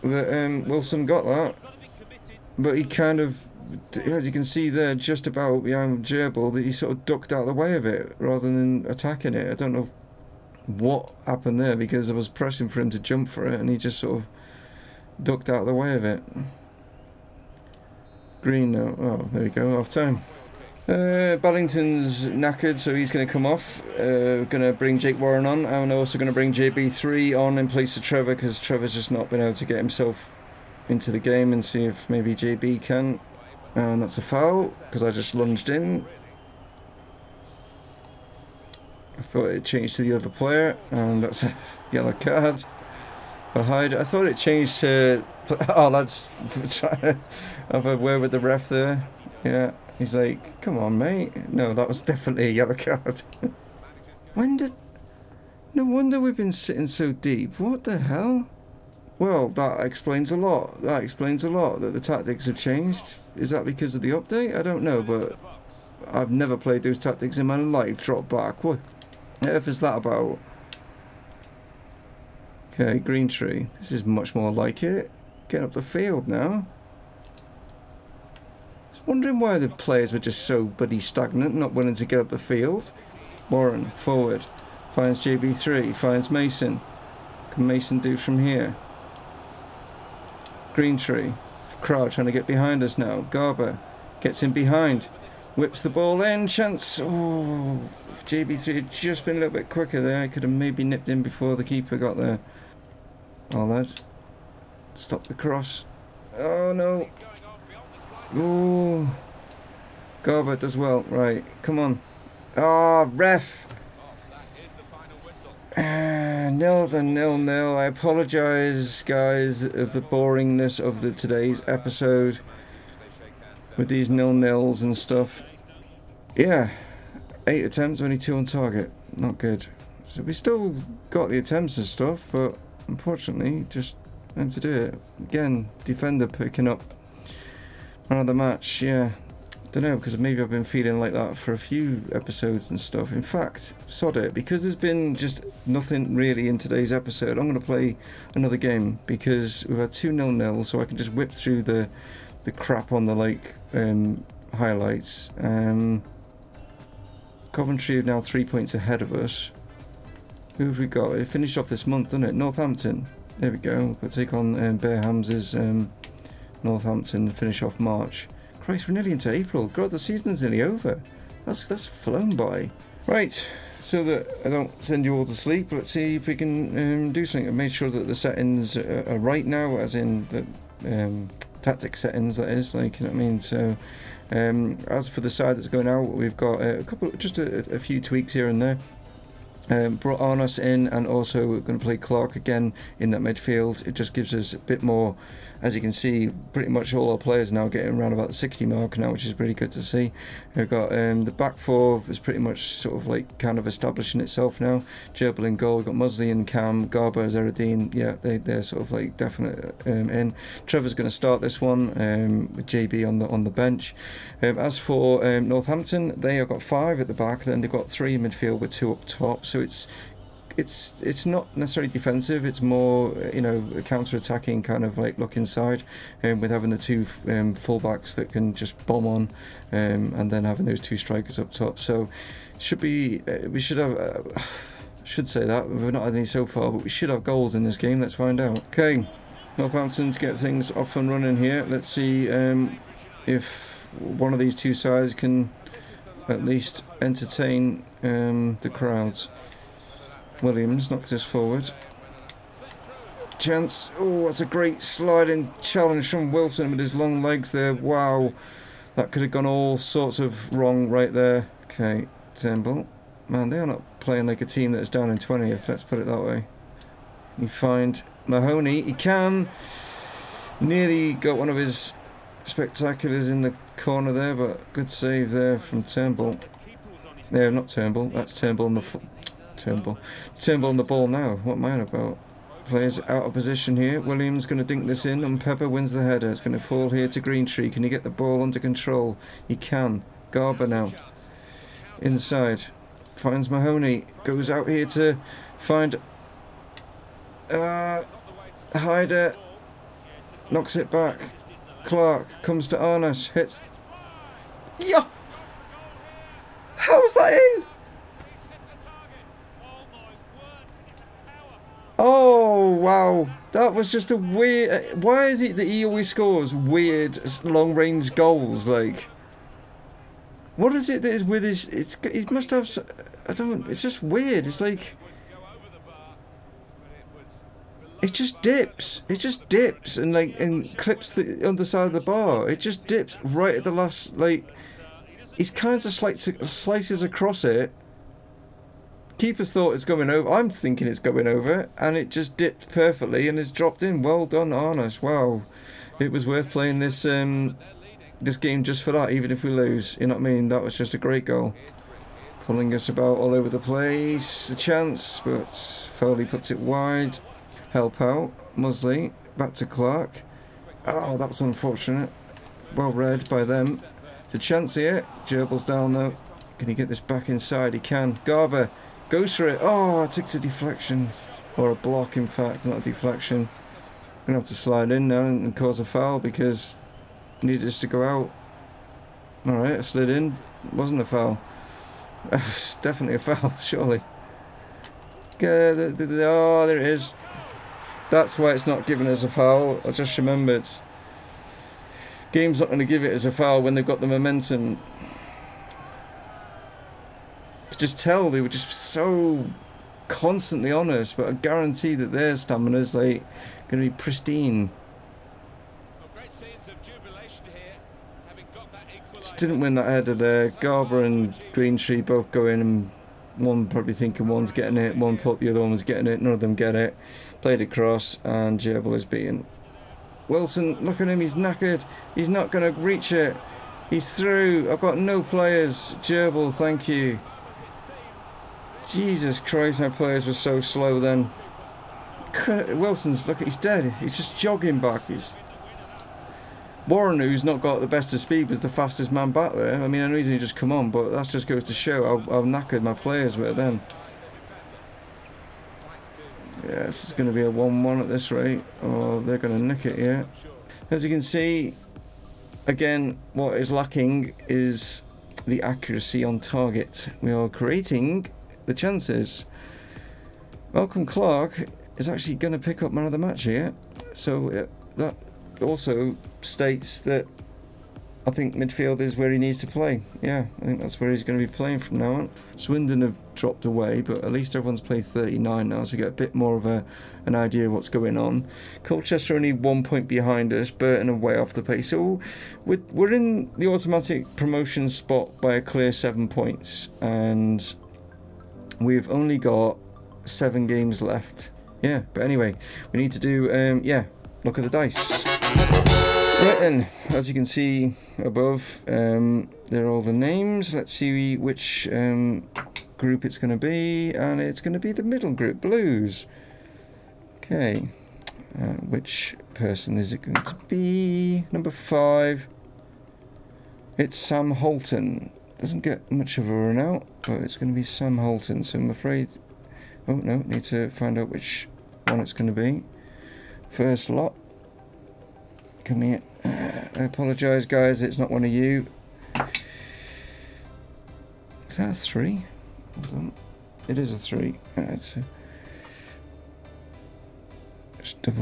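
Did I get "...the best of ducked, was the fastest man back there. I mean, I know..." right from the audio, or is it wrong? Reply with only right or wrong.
wrong.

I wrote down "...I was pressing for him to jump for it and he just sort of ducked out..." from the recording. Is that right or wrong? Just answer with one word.
right.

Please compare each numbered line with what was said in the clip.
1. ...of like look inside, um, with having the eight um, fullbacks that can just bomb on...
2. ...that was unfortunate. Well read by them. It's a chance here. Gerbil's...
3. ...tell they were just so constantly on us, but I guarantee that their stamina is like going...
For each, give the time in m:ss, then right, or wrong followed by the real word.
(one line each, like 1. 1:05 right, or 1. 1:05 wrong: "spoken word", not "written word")
1. 3:44 wrong: "two", not "eight"
2. 6:01 right
3. 6:37 right.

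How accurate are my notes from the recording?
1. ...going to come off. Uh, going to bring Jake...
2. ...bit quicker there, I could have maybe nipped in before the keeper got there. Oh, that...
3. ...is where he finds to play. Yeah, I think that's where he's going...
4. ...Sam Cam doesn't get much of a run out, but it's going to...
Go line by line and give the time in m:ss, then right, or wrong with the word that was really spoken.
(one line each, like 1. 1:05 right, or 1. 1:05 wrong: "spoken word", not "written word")
1. 0:23 right
2. 1:39 right
3. 7:48 wrong: "needs", not "finds"
4. 8:34 wrong: "Holton", not "Cam".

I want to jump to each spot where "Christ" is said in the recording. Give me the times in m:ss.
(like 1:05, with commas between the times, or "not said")
2:48, 7:09.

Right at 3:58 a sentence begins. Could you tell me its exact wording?
Okay, Northampton to get things off and running here.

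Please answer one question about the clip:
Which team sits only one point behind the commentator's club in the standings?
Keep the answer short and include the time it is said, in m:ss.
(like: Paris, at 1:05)
Colchester, at 7:58.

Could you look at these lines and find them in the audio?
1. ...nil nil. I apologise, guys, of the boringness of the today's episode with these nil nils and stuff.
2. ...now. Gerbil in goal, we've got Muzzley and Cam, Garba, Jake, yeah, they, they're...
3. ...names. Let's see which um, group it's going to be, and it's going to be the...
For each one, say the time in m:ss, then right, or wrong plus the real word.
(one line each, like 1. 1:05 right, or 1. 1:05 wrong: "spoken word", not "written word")
1. 1:57 right
2. 3:24 wrong: "Zeradine", not "Jake"
3. 8:20 right.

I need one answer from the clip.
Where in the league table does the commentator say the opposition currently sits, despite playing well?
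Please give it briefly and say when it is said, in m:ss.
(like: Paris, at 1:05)
20th, at 4:25.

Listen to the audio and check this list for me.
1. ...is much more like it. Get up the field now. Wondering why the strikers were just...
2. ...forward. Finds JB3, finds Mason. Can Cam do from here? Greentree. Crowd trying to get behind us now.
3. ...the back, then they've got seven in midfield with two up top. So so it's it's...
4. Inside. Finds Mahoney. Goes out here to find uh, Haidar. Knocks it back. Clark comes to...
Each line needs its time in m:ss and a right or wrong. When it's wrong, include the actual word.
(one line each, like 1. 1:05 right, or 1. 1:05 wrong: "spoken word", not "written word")
1. 1:13 wrong: "players", not "strikers"
2. 1:23 wrong: "Mason", not "Cam"
3. 3:37 wrong: "three", not "seven"
4. 4:52 right.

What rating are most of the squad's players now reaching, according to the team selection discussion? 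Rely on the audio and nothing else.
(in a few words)
60.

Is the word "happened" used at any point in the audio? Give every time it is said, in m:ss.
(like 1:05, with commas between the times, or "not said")
0:11.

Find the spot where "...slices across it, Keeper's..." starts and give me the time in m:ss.
5:36.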